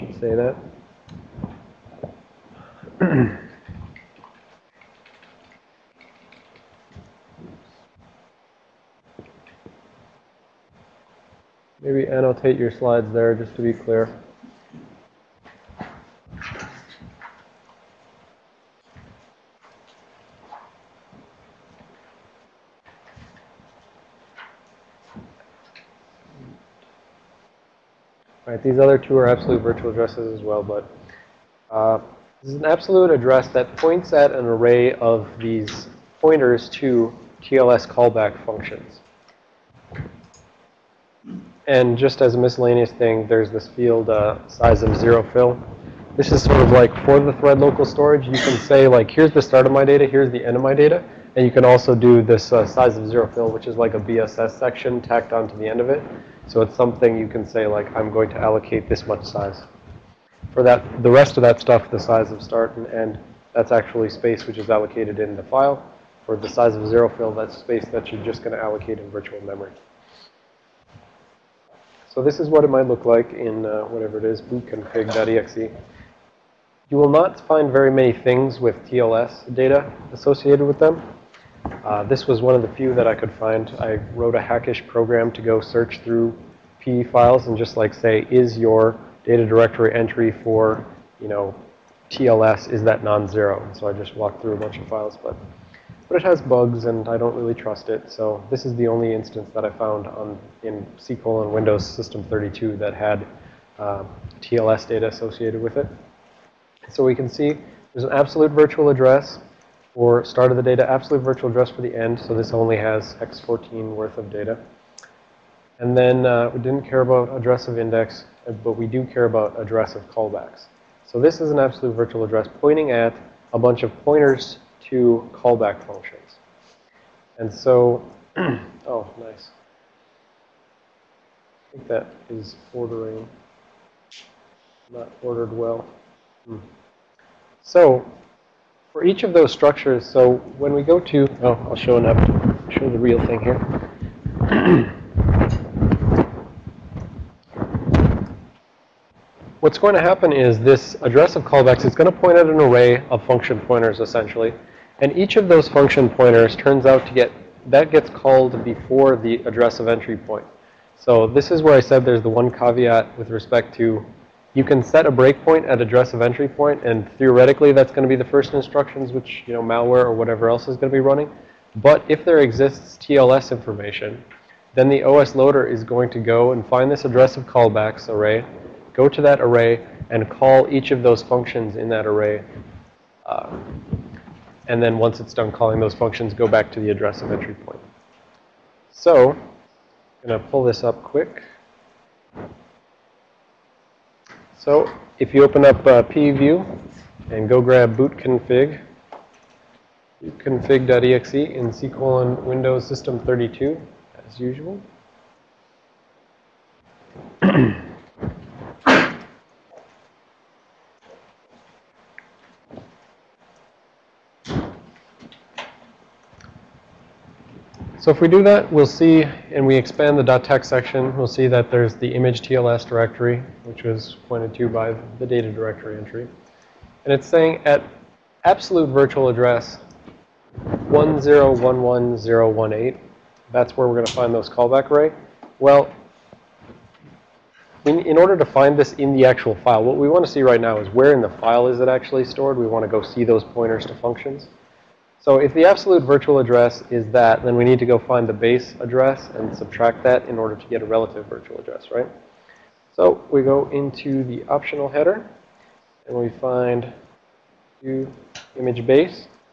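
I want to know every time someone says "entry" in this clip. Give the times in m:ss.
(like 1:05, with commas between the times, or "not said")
1:29, 2:39, 2:46, 3:07, 3:45.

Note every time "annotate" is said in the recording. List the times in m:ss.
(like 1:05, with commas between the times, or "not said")
0:12.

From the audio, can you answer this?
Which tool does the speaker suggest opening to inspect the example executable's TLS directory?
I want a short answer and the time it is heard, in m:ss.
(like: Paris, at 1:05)
pview, at 3:16.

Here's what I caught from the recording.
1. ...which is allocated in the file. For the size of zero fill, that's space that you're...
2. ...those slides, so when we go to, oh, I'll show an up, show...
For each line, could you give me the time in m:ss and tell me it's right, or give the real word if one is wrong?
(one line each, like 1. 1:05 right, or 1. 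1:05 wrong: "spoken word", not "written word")
1. 1:04 right
2. 2:19 wrong: "structures", not "slides".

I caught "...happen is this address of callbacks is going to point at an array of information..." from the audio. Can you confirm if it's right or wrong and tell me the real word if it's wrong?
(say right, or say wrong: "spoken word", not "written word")
wrong: "function", not "information".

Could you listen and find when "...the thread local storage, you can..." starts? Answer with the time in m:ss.
0:47.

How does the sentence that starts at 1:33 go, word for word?
So I just walked through a bunch of files, but, but it has bugs and I don't really trust it.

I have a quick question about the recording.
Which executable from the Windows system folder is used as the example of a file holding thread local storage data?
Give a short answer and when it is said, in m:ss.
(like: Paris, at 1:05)
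bootconfig.exe, at 1:14.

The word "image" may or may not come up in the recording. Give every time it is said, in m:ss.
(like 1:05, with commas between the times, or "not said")
3:42, 4:18.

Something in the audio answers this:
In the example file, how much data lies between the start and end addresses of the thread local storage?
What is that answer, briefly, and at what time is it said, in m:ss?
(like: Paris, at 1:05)
X14, at 1:53.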